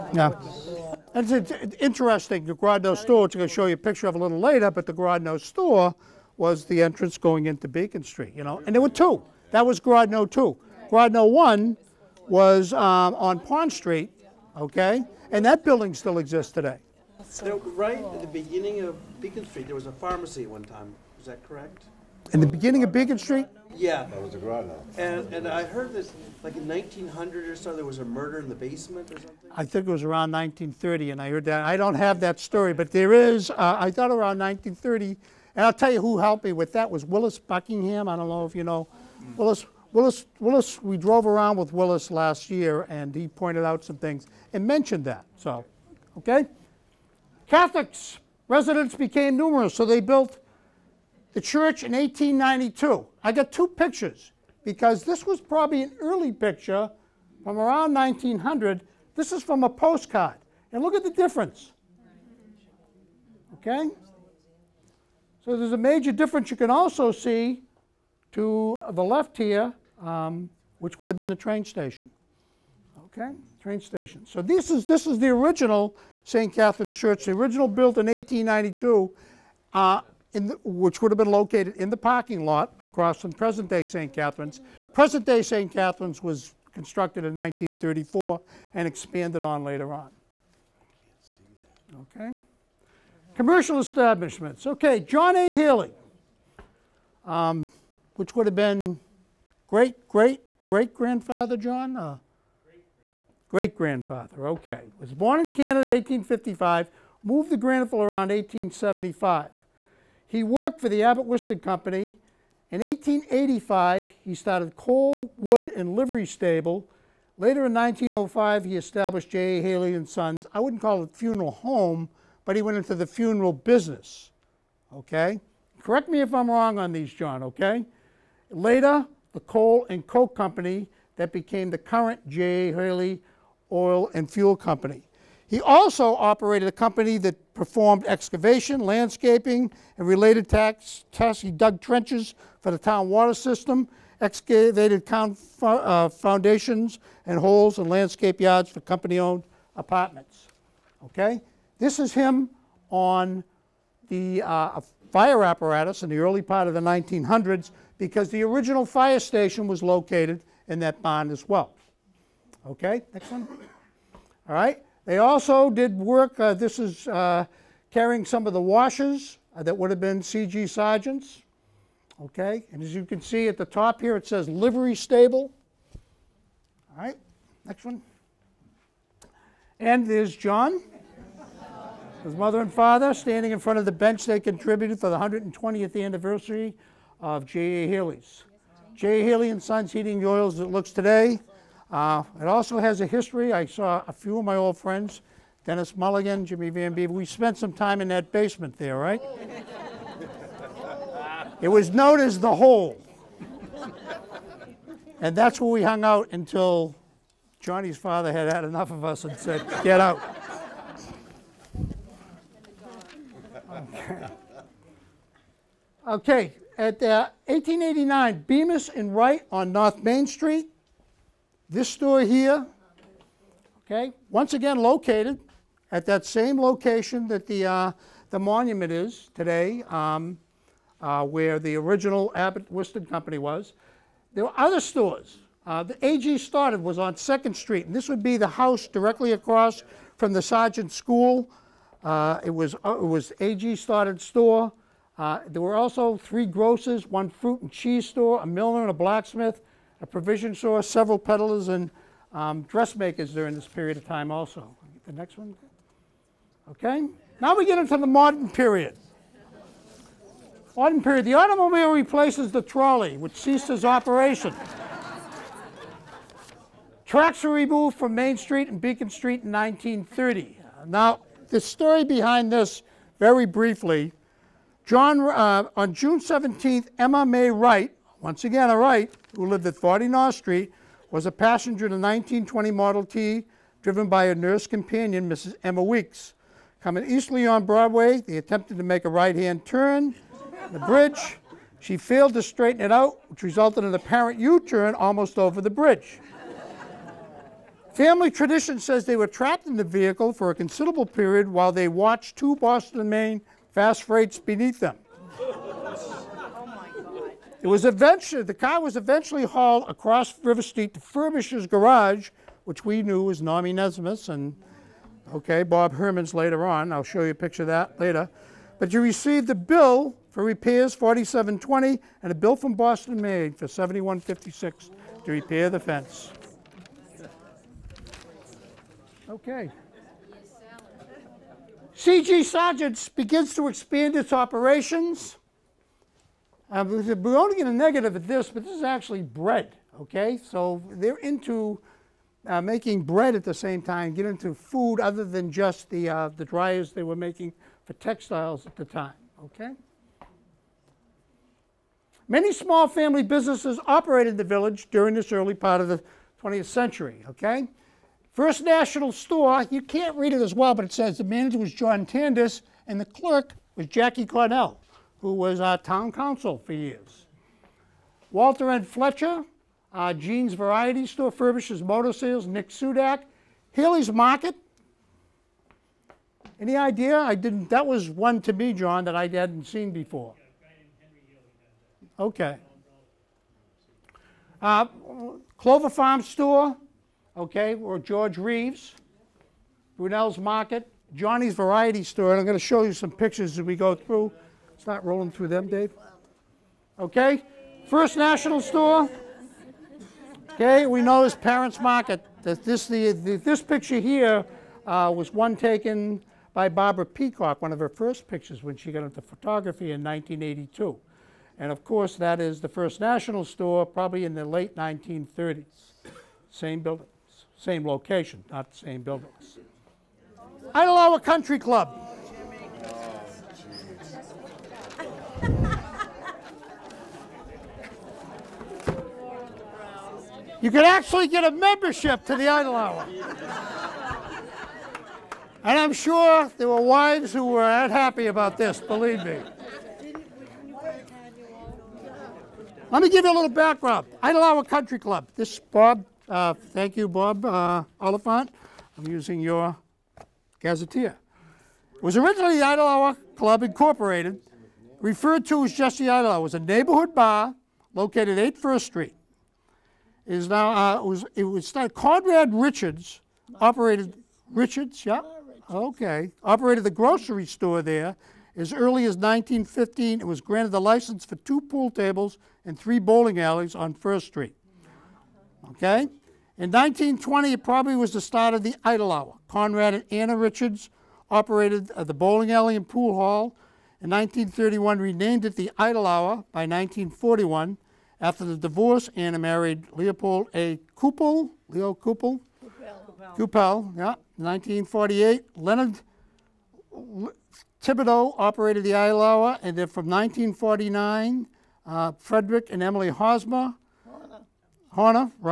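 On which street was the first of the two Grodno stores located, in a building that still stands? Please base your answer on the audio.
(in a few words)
Pond Street.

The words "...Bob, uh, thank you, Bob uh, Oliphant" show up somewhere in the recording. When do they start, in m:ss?
7:25.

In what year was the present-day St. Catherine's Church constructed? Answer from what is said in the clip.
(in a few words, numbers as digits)
1934.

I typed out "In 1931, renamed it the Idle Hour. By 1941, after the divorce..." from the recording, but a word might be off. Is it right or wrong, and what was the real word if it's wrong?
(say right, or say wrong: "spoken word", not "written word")
right.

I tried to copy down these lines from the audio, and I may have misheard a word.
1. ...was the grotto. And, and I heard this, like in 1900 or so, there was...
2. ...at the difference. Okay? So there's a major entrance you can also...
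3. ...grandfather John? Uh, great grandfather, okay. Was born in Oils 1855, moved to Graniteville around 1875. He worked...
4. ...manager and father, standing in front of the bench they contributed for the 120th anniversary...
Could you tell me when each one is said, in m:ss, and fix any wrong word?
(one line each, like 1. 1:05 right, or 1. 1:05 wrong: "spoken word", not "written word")
1. 0:24 right
2. 1:00 wrong: "difference", not "entrance"
3. 1:40 wrong: "Canada", not "Oils"
4. 3:02 wrong: "mother", not "manager".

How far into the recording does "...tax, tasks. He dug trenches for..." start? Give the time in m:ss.
2:20.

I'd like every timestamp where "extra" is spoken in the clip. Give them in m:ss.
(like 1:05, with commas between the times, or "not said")
not said.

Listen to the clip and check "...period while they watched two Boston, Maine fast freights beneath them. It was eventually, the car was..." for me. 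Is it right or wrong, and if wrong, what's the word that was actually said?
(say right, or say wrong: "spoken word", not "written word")
right.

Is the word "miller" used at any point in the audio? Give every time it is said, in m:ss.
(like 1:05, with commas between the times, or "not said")
4:08.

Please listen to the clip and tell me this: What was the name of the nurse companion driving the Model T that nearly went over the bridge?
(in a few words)
Emma Weeks.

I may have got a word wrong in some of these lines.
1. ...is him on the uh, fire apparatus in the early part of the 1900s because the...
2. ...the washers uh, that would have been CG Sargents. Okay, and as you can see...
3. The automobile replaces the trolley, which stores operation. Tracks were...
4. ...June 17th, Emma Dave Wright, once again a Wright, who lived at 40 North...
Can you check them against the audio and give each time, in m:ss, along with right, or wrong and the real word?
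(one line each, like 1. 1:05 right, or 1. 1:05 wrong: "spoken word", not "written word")
1. 2:31 right
2. 2:48 right
3. 4:21 wrong: "ceases", not "stores"
4. 4:35 wrong: "May", not "Dave".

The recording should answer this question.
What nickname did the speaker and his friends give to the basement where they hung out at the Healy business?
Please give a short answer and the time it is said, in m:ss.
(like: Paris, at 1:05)
the hole, at 3:22.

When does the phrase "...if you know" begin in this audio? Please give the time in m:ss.
0:38.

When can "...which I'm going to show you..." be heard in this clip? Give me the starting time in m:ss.
0:03.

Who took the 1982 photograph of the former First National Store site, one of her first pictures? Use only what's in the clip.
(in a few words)
Barbara Peacock.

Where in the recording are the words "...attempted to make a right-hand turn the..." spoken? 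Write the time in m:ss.
4:48.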